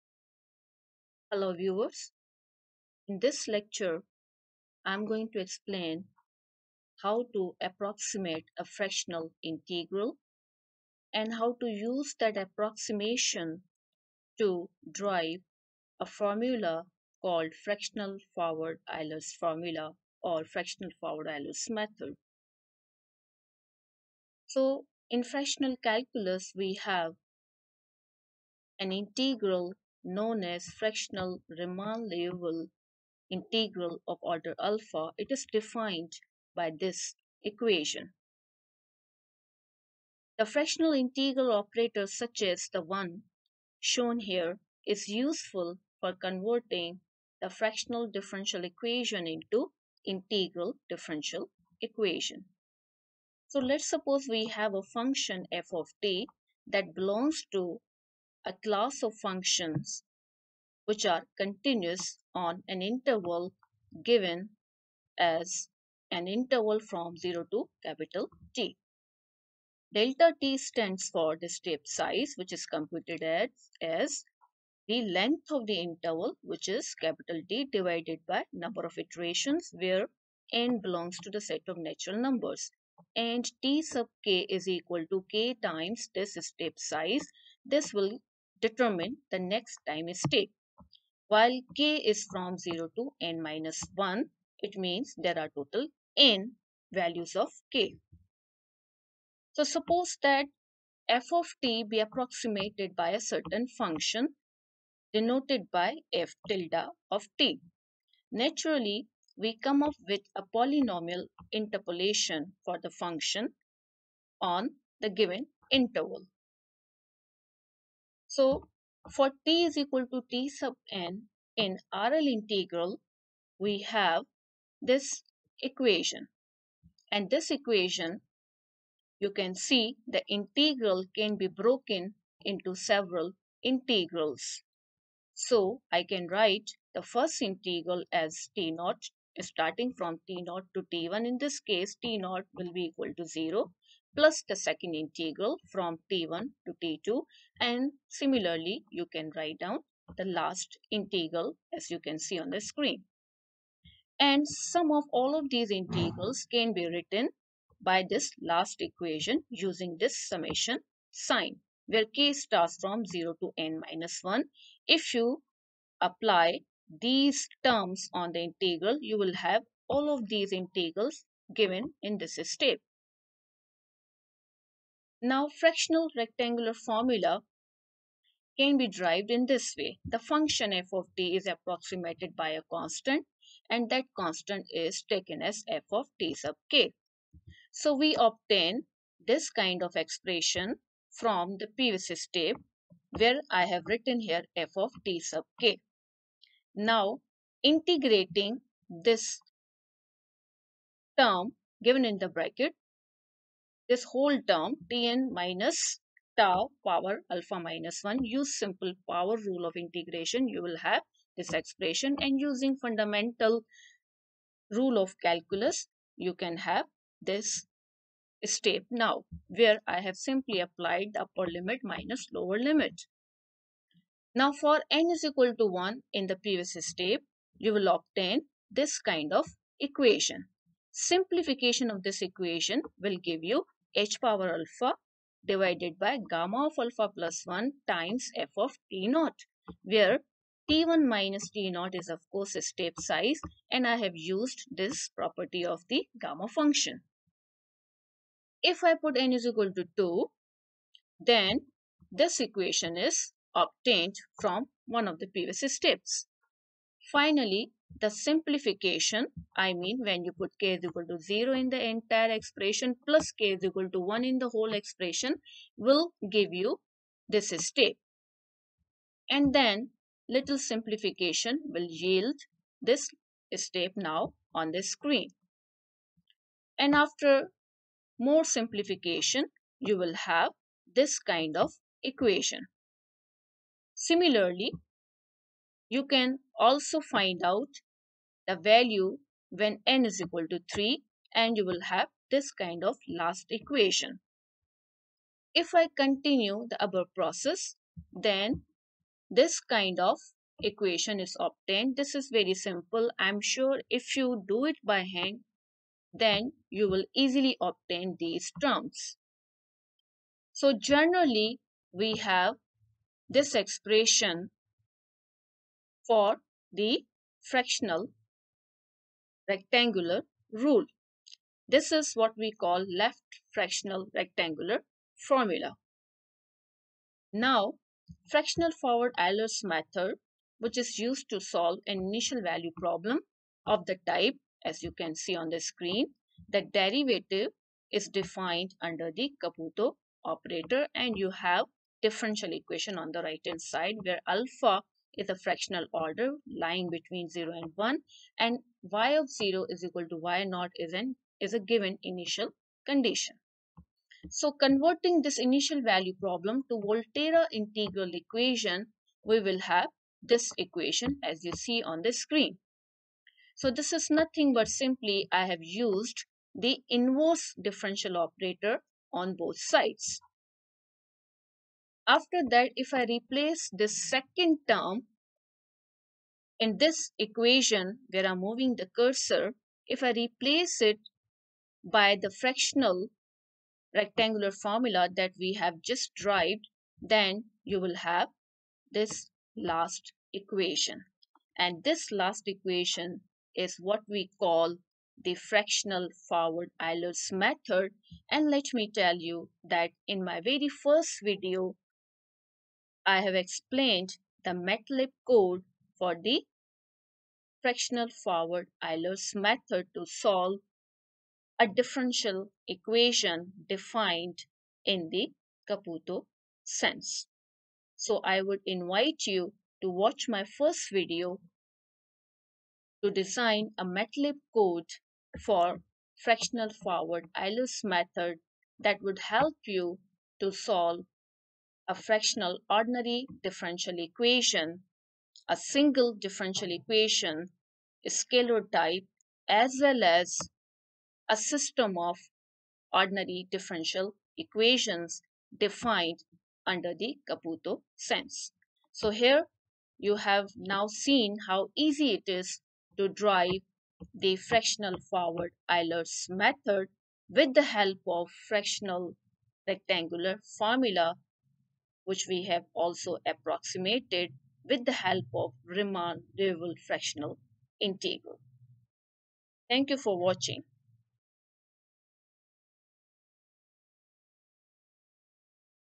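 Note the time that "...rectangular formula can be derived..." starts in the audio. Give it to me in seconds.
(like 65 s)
176 s.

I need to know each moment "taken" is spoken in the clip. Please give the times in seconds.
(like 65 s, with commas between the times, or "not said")
185 s.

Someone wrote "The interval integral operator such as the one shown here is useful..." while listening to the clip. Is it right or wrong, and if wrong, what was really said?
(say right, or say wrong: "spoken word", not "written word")
wrong: "fractional", not "interval".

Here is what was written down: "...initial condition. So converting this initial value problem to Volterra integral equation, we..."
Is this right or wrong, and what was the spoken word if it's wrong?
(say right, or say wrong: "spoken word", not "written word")
right.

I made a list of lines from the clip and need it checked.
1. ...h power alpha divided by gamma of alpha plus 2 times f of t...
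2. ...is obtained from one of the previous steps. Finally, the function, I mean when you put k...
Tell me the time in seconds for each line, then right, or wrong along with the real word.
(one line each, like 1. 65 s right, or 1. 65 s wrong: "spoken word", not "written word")
1. 233 s wrong: "1", not "2"
2. 252 s wrong: "simplification", not "function".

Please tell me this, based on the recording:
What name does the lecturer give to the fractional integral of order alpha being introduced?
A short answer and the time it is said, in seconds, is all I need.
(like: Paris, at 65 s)
Riemann Liouville integral, at 31 s.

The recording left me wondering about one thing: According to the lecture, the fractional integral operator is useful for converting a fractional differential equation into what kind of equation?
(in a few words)
integral differential equation.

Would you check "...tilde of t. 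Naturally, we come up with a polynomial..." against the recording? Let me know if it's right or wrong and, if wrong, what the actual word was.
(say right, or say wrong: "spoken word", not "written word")
right.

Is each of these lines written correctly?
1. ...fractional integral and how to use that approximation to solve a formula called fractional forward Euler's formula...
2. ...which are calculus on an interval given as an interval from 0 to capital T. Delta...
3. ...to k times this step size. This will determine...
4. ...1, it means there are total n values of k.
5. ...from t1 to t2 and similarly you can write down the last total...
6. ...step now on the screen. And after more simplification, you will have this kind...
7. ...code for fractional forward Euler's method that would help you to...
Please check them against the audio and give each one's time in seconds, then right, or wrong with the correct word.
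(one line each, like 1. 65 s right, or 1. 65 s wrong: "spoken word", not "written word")
1. 8 s wrong: "drive", not "solve"
2. 60 s wrong: "continuous", not "calculus"
3. 85 s right
4. 93 s right
5. 145 s wrong: "integral", not "total"
6. 273 s right
7. 424 s right.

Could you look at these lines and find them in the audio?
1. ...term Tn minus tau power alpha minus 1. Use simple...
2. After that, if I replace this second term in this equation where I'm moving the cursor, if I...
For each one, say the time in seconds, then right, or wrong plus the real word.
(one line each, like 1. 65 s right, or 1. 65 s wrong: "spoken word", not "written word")
1. 204 s right
2. 372 s right.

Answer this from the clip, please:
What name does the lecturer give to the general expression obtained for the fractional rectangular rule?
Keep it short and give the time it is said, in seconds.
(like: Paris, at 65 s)
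left fractional rectangular formula, at 322 s.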